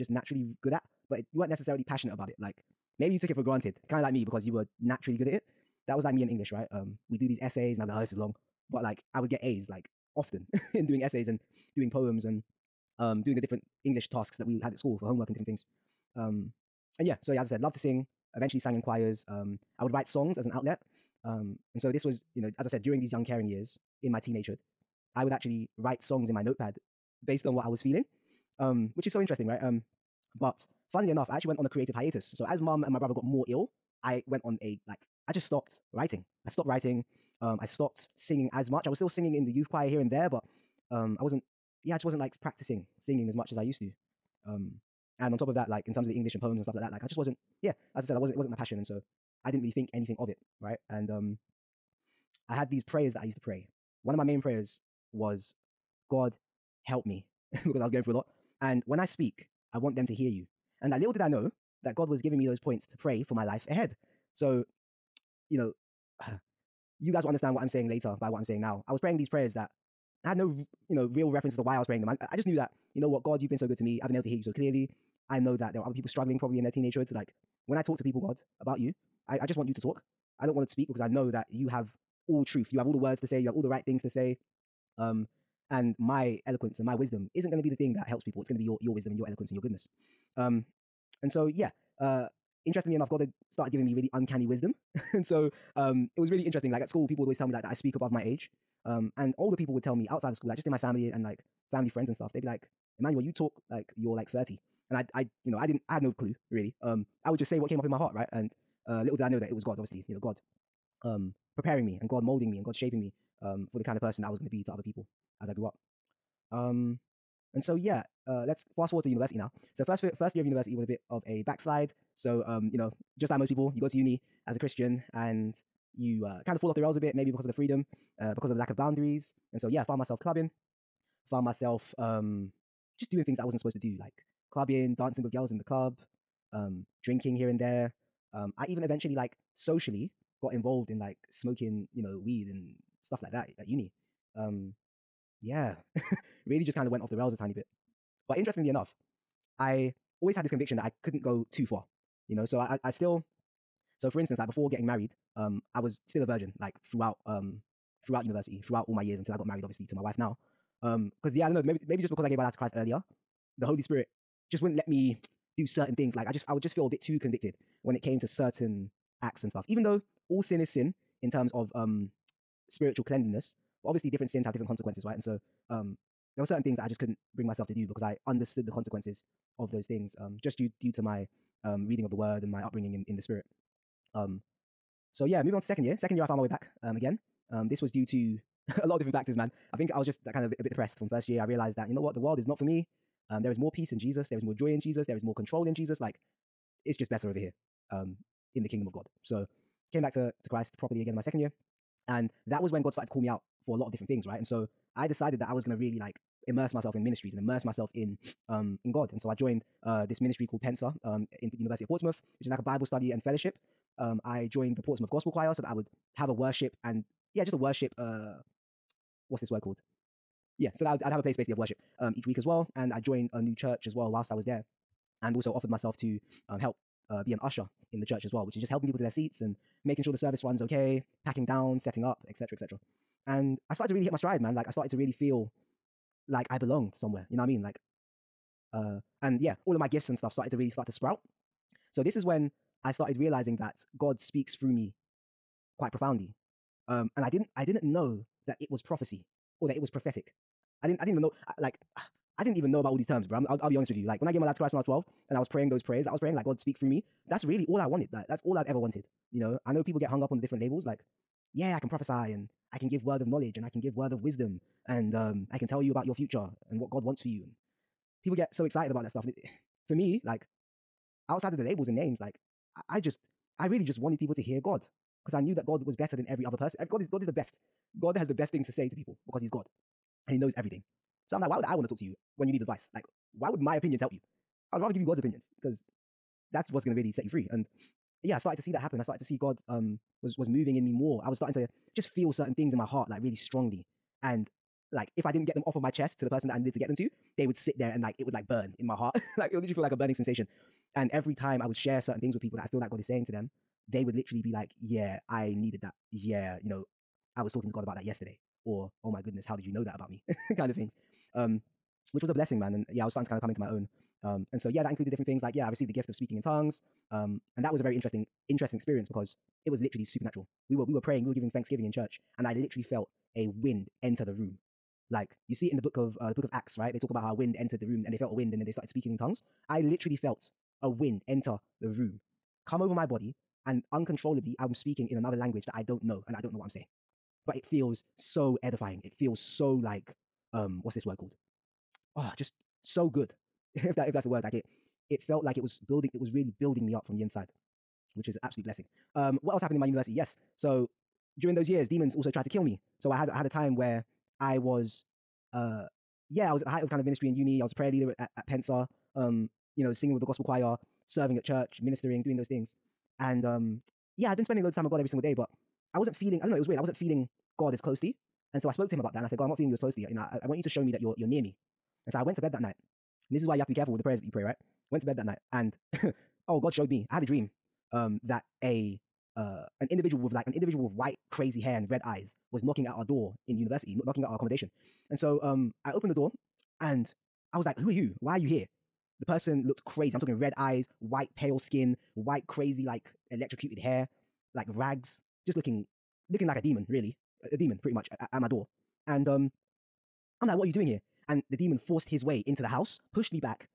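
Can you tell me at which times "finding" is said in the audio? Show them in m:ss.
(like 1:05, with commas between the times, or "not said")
not said.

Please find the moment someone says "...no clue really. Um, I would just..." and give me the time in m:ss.
1:46.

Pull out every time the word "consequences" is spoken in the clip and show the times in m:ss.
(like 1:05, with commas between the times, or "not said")
2:54, 2:58.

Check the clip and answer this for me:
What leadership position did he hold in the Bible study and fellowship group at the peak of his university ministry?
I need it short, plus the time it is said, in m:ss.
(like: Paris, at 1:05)
prayer leader, at 5:57.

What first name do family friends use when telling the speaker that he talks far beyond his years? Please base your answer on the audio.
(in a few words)
Emmanuel.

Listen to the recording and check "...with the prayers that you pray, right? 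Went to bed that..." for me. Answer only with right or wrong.
right.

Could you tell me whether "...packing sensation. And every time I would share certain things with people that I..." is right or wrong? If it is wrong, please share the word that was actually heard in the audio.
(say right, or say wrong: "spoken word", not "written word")
wrong: "burning", not "packing".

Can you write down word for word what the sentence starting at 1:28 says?
It's going to be your your wisdom and your eloquence and your goodness.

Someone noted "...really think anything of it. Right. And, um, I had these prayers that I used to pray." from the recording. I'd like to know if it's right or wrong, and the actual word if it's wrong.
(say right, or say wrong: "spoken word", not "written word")
right.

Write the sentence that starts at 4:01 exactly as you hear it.
So this is when I started realizing that God speaks through me quite profoundly.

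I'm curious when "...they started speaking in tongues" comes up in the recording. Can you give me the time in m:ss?
5:28.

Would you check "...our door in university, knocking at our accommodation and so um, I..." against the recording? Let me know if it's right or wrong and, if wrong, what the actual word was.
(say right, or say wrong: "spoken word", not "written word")
right.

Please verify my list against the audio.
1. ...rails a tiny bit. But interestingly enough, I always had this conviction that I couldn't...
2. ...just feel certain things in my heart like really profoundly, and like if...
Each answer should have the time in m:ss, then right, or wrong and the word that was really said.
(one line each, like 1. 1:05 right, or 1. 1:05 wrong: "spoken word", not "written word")
1. 2:27 right
2. 4:51 wrong: "strongly", not "profoundly".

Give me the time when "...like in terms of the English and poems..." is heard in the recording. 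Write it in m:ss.
0:45.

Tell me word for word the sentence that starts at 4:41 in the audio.
So I'm like, why would I want to talk to you when you need advice?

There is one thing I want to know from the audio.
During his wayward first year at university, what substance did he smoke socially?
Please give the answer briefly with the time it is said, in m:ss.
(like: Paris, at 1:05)
weed, at 2:22.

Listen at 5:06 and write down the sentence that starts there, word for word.
Yeah, you know, I was talking to God about that yesterday.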